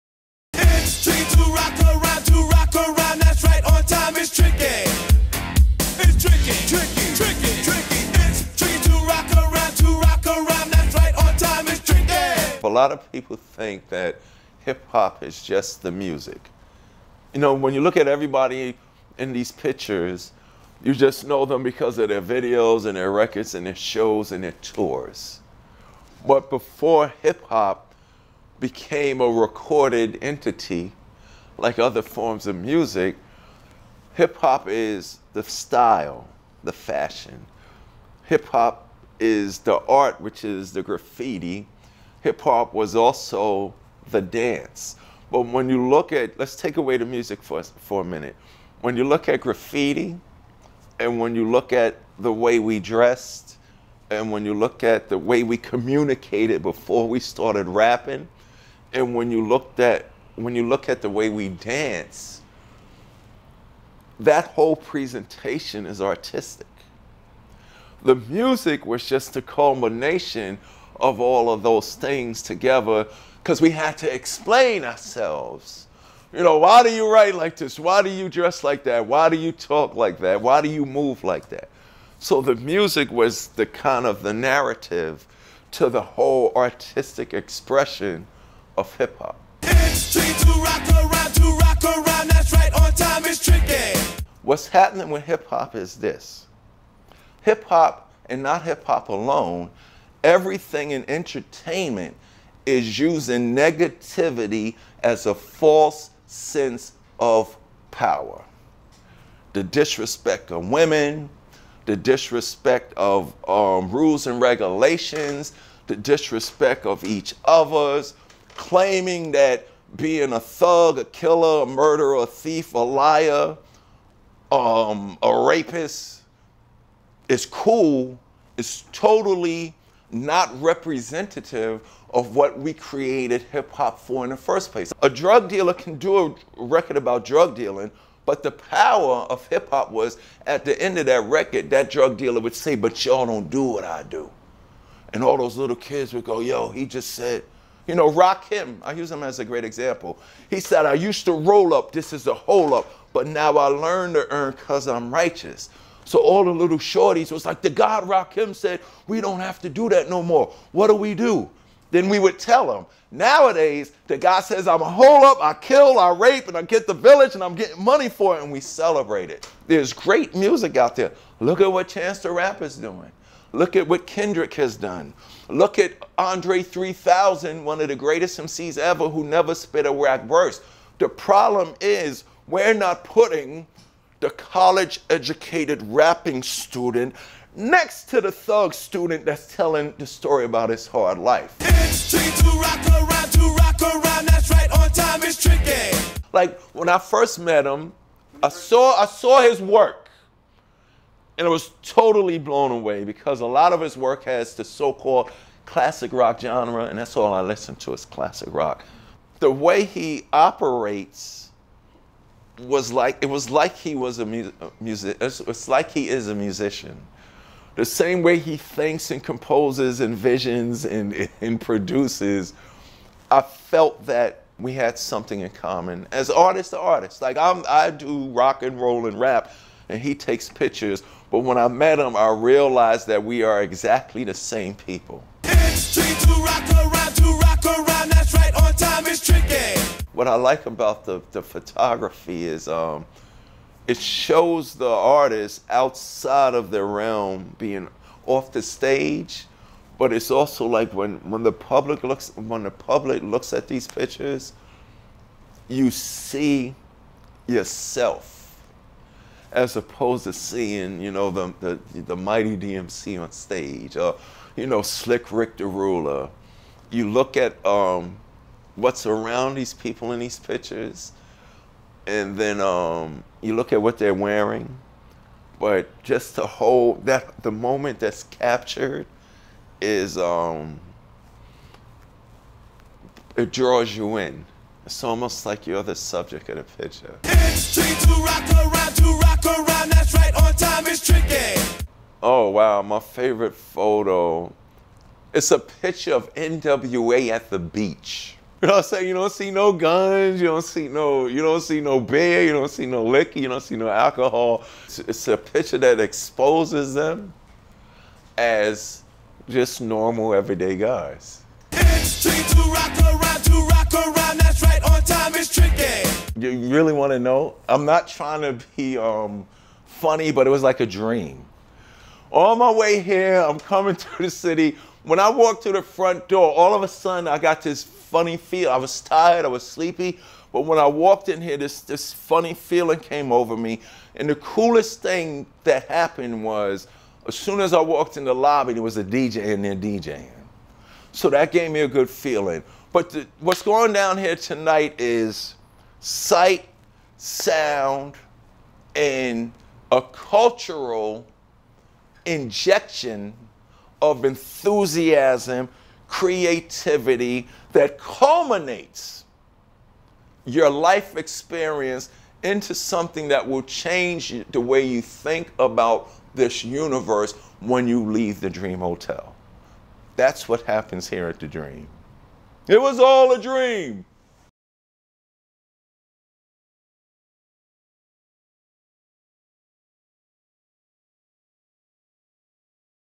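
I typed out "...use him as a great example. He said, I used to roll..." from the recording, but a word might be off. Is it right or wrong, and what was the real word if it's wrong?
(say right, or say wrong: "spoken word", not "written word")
right.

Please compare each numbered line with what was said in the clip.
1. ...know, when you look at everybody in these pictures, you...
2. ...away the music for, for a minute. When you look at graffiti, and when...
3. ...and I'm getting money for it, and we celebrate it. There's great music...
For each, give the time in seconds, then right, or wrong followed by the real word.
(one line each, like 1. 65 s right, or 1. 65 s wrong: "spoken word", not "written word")
1. 17 s right
2. 46 s right
3. 167 s right.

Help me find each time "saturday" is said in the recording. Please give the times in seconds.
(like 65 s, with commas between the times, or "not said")
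not said.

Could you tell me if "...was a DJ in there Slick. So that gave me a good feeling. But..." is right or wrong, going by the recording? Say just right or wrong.
wrong.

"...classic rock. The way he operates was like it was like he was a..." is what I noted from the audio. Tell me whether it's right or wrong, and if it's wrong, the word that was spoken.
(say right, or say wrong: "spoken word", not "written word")
right.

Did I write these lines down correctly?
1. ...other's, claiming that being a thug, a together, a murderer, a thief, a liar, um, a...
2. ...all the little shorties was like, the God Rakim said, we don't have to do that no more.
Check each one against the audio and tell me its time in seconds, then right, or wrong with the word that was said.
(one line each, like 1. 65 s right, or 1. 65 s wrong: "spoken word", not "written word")
1. 117 s wrong: "killer", not "together"
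2. 156 s right.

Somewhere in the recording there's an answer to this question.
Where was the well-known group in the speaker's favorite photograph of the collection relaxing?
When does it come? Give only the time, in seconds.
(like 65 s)
297 s.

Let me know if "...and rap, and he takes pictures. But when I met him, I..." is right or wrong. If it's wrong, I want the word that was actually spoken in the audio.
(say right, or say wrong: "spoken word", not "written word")
right.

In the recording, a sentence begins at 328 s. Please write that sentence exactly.
I was tired, I was sleepy, but when I walked in here, this, this funny feeling came over me.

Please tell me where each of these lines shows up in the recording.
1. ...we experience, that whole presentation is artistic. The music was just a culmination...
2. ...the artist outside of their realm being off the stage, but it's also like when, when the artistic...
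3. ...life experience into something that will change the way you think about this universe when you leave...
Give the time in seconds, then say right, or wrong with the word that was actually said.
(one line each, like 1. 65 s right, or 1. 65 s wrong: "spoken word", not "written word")
1. 61 s wrong: "dance", not "experience"
2. 244 s wrong: "public", not "artistic"
3. 360 s right.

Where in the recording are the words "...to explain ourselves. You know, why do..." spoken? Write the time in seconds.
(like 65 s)
73 s.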